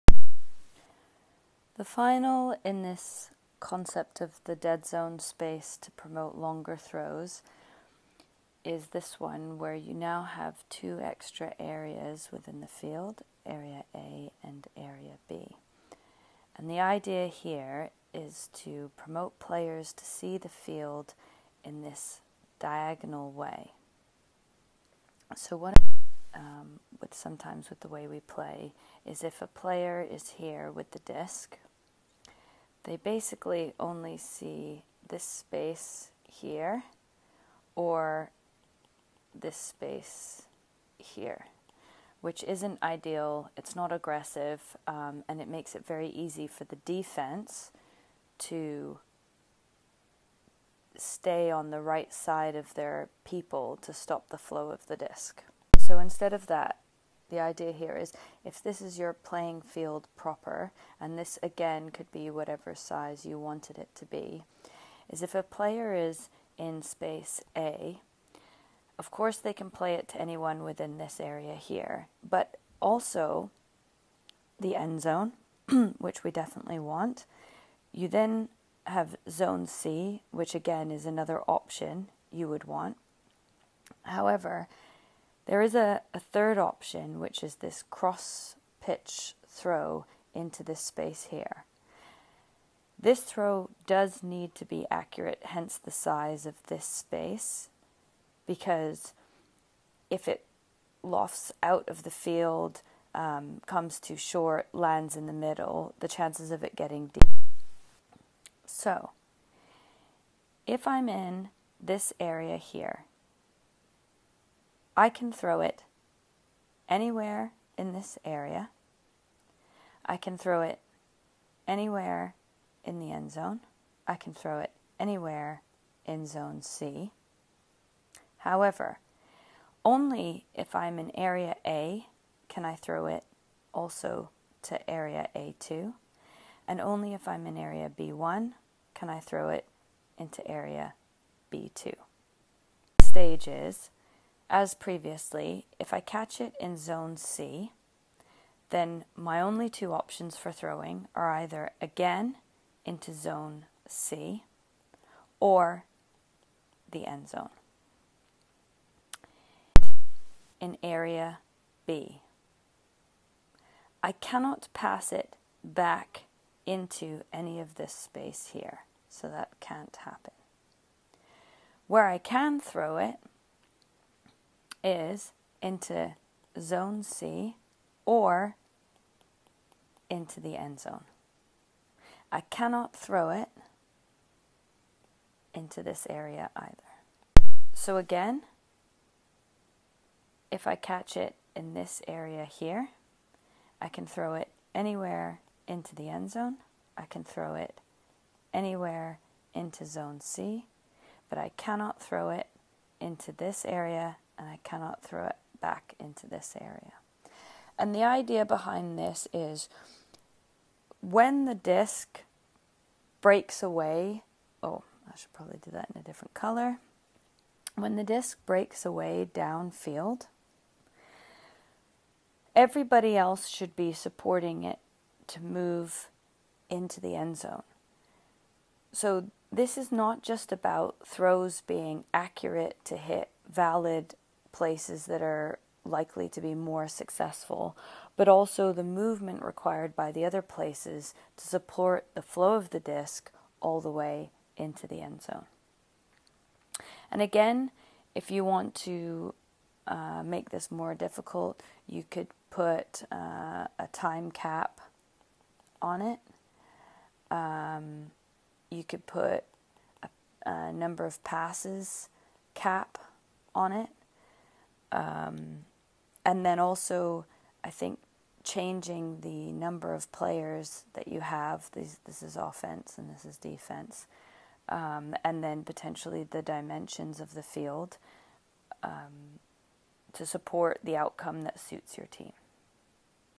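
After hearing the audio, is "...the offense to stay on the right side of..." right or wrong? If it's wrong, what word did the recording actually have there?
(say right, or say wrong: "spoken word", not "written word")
wrong: "defense", not "offense".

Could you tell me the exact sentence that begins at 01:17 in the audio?
You then have zone C, which again is another option you would want.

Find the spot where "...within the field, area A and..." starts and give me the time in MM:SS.
00:12.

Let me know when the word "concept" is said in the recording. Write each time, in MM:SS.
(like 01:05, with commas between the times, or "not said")
00:03.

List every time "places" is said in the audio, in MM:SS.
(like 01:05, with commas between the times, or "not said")
03:54, 04:00.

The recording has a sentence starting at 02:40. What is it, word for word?
In area B, I cannot pass it back into any of this space here, so that can't happen.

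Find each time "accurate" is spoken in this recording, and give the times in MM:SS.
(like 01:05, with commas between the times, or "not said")
01:34, 03:52.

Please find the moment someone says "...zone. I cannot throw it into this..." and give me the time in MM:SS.
03:00.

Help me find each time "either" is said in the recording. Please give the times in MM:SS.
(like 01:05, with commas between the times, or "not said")
02:31, 03:06.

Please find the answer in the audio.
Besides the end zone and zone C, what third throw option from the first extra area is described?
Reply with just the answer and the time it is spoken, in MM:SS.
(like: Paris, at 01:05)
cross pitch throw, at 01:27.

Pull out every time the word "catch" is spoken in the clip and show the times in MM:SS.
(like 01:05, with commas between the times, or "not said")
02:26, 03:10.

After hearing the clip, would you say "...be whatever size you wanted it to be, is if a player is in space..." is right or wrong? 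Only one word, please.
right.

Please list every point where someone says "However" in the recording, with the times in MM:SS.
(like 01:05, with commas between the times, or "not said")
01:24, 02:08.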